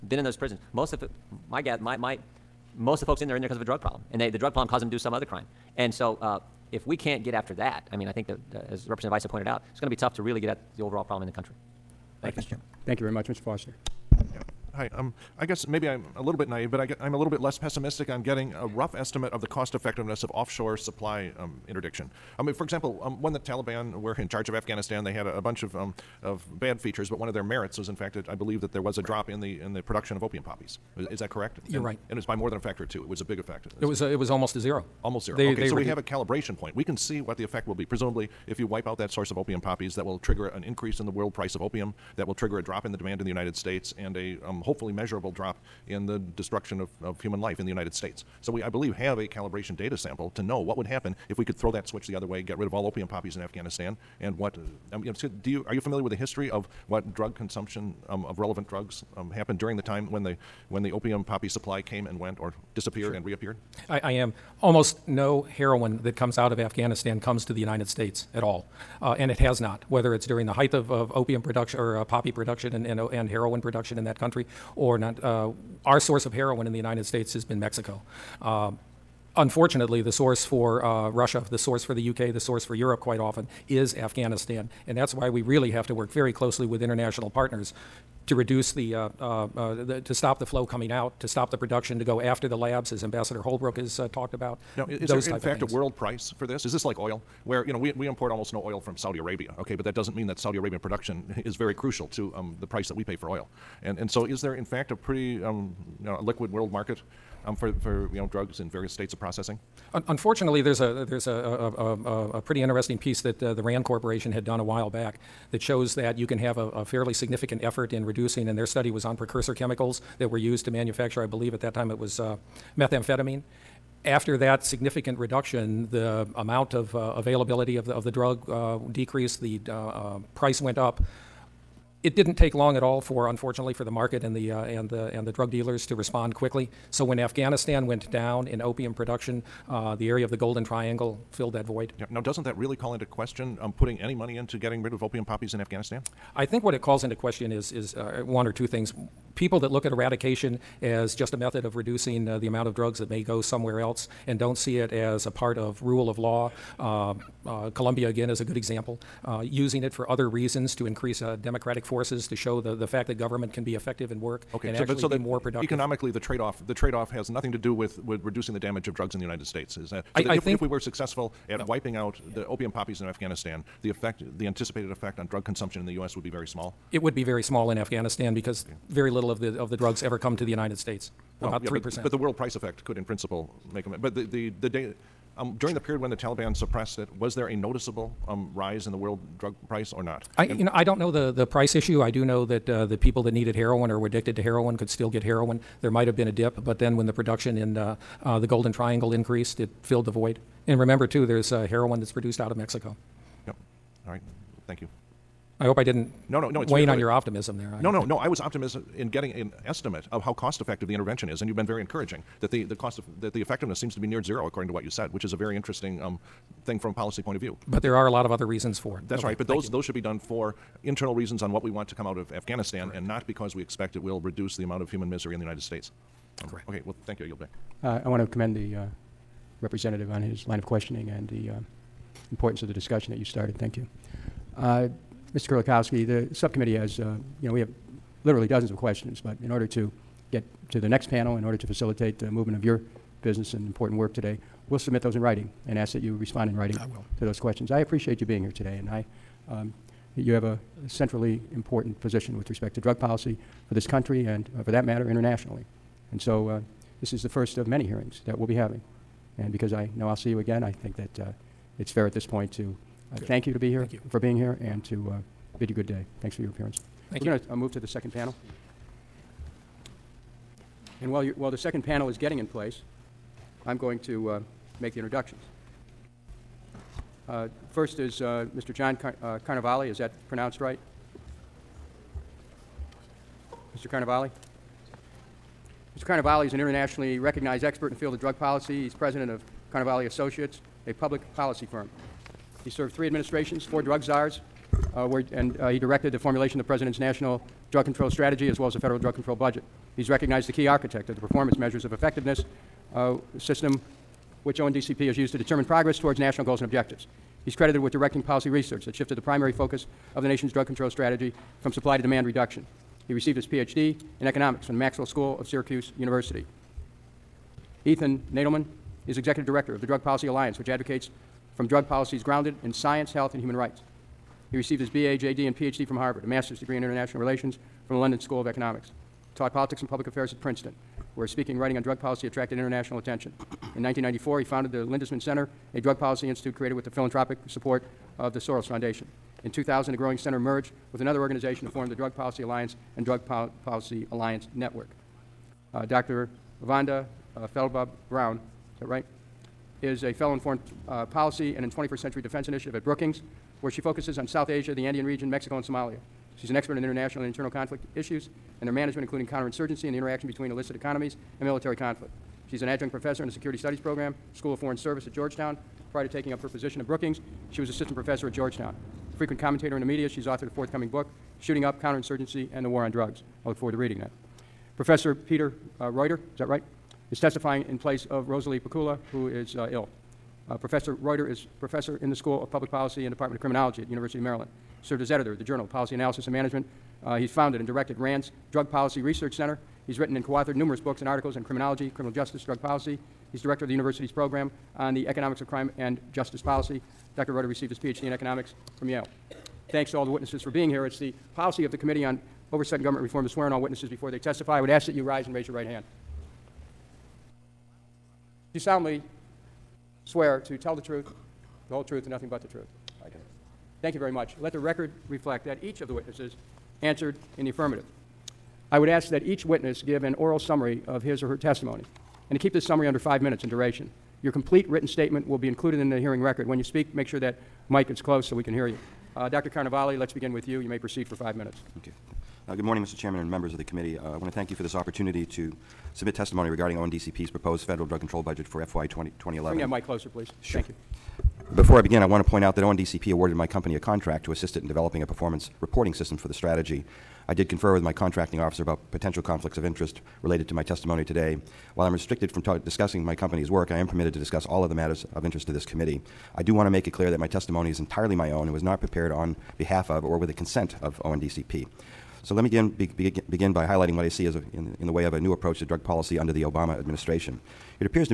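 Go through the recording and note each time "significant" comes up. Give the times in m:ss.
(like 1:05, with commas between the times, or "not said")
1:57, 2:04.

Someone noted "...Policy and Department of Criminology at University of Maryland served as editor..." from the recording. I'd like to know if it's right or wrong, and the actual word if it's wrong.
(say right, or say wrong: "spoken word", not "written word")
right.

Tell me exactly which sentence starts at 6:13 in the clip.
I look forward to reading that.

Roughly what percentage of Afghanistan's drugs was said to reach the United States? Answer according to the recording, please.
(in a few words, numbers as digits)
3 percent.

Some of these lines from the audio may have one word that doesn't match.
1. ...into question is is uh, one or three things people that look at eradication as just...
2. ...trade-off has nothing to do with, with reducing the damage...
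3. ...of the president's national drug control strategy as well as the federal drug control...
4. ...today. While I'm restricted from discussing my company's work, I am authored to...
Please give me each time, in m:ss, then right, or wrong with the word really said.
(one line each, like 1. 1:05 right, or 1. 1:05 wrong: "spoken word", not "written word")
1. 2:27 wrong: "two", not "three"
2. 2:46 right
3. 4:56 right
4. 7:31 wrong: "permitted", not "authored".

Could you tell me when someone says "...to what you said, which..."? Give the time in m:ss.
3:34.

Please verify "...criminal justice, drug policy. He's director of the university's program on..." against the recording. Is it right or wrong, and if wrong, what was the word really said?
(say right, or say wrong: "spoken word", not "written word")
right.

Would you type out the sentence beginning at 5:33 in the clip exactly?
In 1994, he founded the Lindesmith Center, a drug policy institute created with the philanthropic support of the Soros Foundation.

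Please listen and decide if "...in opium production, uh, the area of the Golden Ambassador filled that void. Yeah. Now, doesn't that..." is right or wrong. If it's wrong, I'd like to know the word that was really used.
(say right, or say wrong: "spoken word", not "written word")
wrong: "Triangle", not "Ambassador".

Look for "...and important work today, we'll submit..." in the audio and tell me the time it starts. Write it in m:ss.
4:03.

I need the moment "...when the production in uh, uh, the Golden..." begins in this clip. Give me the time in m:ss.
3:16.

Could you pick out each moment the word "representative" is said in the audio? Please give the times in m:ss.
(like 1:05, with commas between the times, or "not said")
0:08, 3:49.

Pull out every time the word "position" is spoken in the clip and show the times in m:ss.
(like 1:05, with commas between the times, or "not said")
4:12, 6:06.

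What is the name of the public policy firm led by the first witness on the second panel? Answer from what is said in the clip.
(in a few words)
Carnevale Associates.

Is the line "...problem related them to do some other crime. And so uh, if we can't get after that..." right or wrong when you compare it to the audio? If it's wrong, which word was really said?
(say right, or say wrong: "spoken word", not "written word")
wrong: "caused", not "related".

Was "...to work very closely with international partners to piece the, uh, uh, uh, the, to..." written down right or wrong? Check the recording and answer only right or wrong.
wrong.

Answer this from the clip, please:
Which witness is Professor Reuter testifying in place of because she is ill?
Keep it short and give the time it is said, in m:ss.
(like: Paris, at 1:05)
Rosalie Pacula, at 6:18.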